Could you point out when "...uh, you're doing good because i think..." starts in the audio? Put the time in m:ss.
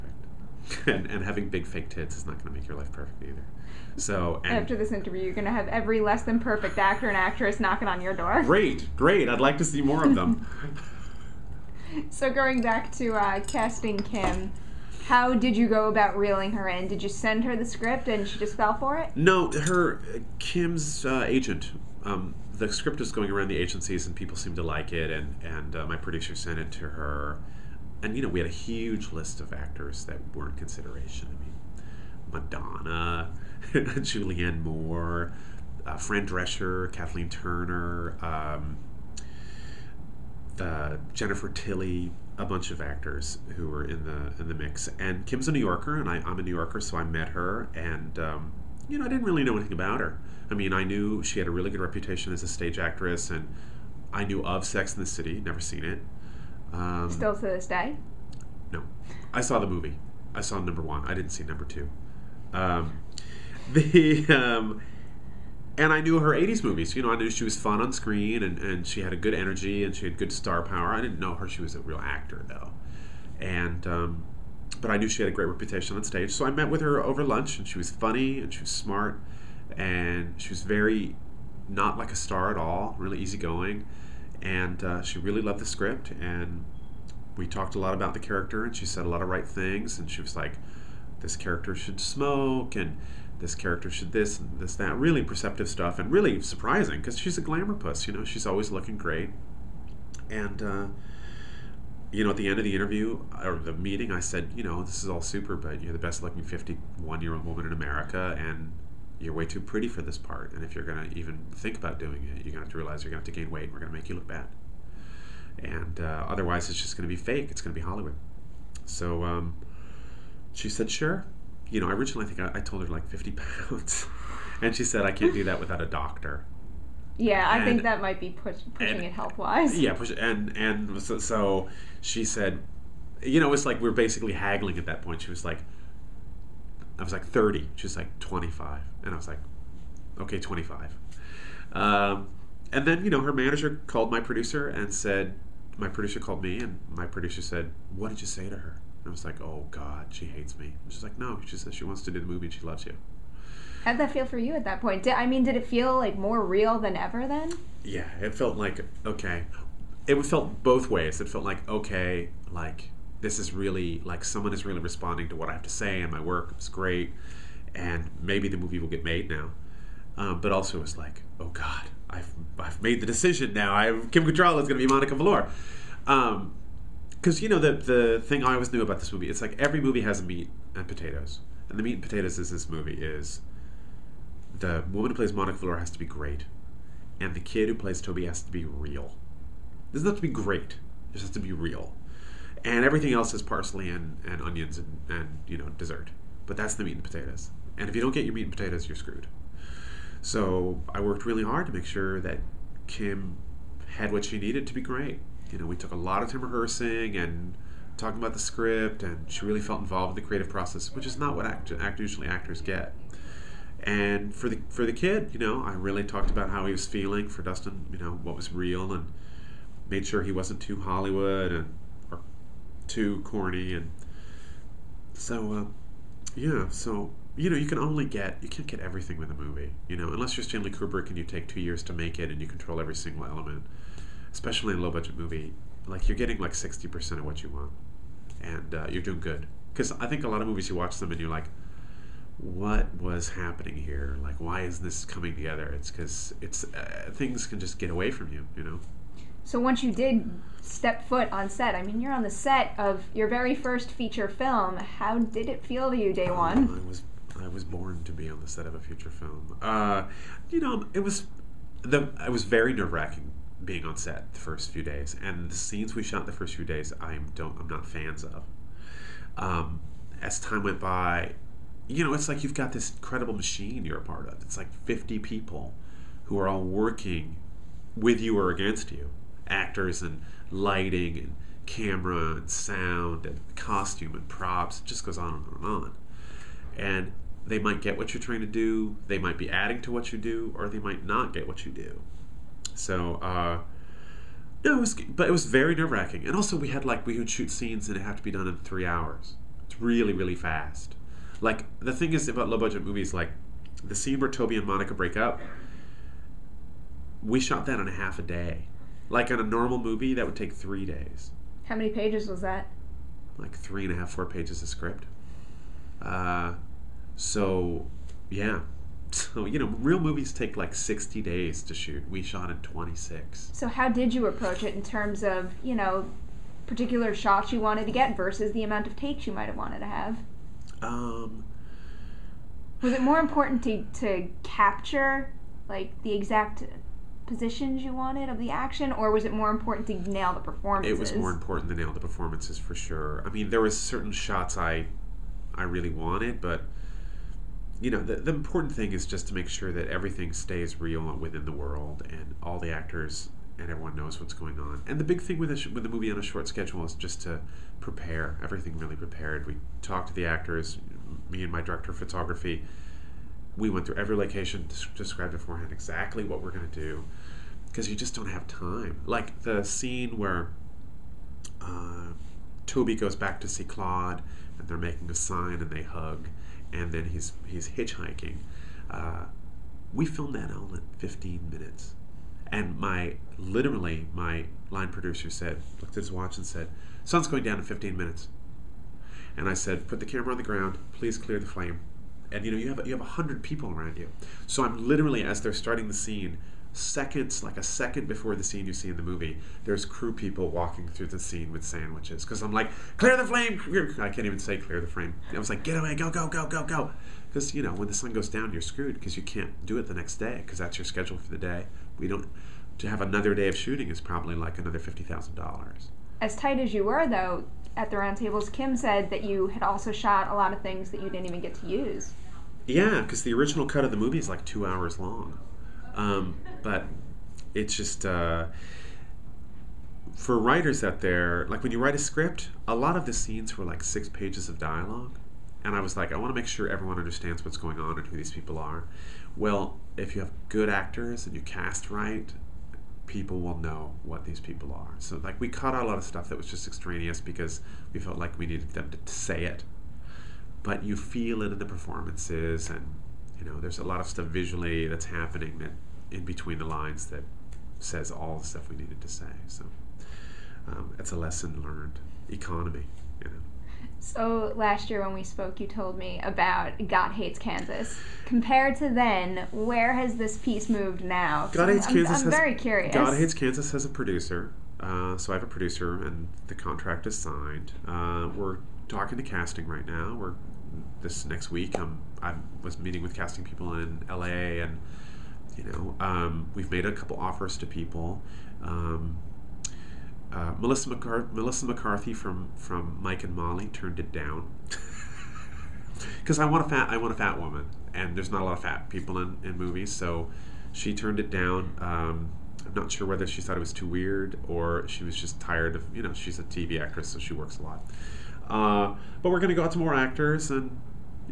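3:58.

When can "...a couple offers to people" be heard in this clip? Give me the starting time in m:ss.
8:06.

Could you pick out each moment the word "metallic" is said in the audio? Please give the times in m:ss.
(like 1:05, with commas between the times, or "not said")
not said.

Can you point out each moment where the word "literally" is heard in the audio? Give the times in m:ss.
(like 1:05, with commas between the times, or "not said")
6:23, 6:34.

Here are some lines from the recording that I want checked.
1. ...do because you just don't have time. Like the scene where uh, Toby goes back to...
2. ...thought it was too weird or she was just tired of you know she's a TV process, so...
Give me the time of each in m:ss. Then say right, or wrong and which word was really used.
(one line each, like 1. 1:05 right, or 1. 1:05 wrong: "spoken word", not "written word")
1. 6:06 right
2. 8:23 wrong: "actress", not "process".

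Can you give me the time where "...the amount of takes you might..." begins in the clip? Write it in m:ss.
5:28.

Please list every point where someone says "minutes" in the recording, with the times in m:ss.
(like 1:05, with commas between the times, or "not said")
6:21, 6:27.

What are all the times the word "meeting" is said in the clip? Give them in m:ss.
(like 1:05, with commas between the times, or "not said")
1:43, 8:02.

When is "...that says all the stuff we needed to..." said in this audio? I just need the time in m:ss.
7:37.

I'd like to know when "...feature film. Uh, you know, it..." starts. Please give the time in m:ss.
4:18.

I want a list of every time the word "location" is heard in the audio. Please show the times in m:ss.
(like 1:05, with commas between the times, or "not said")
6:04.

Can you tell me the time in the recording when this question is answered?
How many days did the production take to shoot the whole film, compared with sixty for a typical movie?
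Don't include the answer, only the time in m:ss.
5:22.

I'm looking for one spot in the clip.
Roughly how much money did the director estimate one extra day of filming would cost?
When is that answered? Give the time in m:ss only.
6:54.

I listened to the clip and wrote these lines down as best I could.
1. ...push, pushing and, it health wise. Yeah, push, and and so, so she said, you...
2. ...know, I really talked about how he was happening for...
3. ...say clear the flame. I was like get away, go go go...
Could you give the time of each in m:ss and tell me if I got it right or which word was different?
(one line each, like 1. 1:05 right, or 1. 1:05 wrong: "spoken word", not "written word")
1. 2:08 right
2. 3:35 wrong: "feeling", not "happening"
3. 6:44 wrong: "frame", not "flame".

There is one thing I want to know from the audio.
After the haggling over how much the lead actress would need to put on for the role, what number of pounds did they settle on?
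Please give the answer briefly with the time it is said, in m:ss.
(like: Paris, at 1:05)
25, at 2:20.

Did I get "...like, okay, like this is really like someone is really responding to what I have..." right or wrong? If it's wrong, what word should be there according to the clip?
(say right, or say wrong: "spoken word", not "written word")
right.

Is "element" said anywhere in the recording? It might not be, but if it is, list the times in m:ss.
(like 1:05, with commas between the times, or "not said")
3:53.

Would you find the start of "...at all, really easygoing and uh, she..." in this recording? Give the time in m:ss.
1:22.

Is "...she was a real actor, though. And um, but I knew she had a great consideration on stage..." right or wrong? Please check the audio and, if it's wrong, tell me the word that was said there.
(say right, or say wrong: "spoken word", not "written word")
wrong: "reputation", not "consideration".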